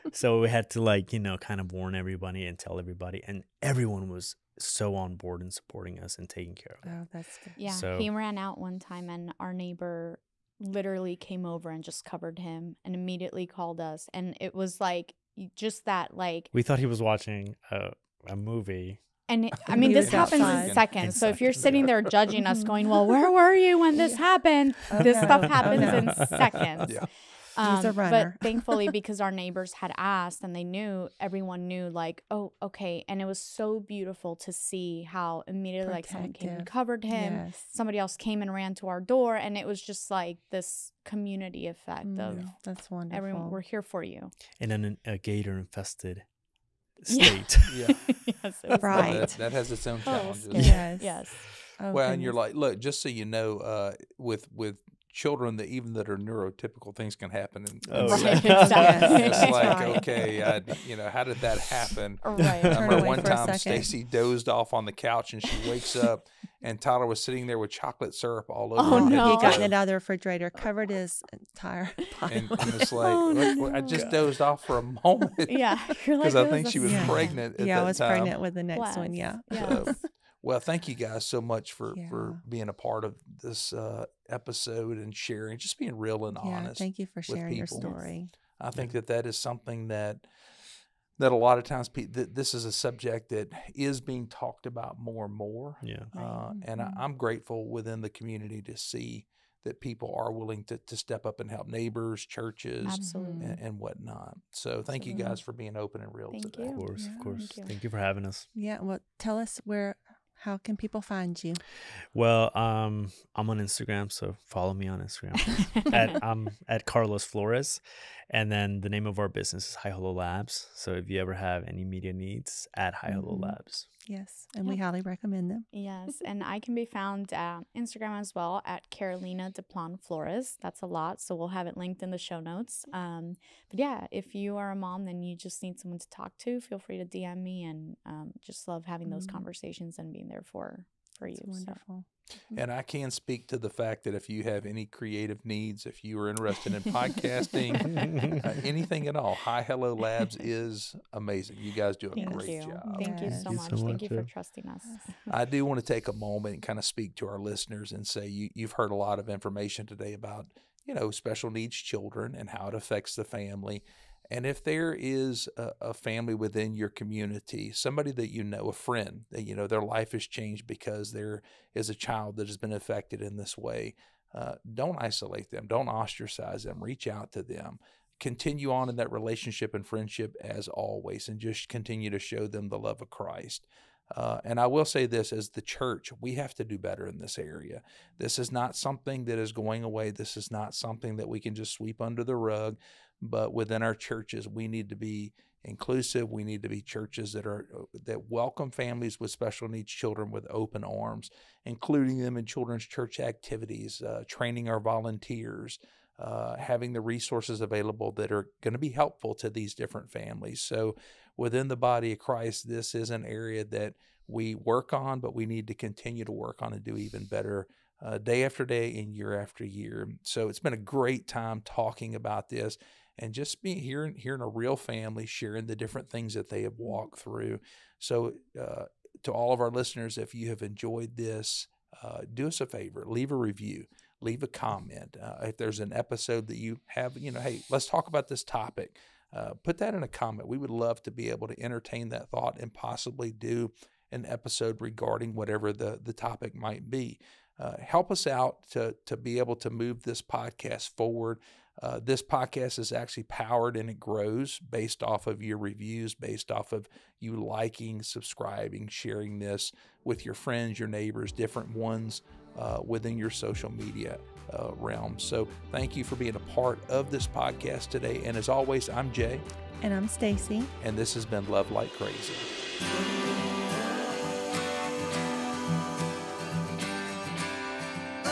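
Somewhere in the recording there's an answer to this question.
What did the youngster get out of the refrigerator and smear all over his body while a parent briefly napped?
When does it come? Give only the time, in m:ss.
1:07.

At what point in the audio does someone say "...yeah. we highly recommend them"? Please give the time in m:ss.
2:04.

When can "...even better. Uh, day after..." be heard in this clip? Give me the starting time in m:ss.
3:36.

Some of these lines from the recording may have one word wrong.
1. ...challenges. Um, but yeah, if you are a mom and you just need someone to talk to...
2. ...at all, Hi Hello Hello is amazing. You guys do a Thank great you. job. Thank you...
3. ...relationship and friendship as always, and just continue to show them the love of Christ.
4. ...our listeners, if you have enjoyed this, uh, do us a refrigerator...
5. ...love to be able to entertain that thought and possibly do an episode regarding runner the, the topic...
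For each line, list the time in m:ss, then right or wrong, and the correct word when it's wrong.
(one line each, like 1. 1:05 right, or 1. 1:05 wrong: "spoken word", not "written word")
1. 2:12 wrong: "notes", not "challenges"
2. 2:29 wrong: "Labs", not "Hello"
3. 2:59 right
4. 3:49 wrong: "favor", not "refrigerator"
5. 4:00 wrong: "whatever", not "runner".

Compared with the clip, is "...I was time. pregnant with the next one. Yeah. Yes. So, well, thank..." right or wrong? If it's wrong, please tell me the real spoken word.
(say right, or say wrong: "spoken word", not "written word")
right.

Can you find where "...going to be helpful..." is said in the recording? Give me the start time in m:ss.
3:28.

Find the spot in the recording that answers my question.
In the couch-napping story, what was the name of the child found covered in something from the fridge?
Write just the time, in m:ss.
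1:06.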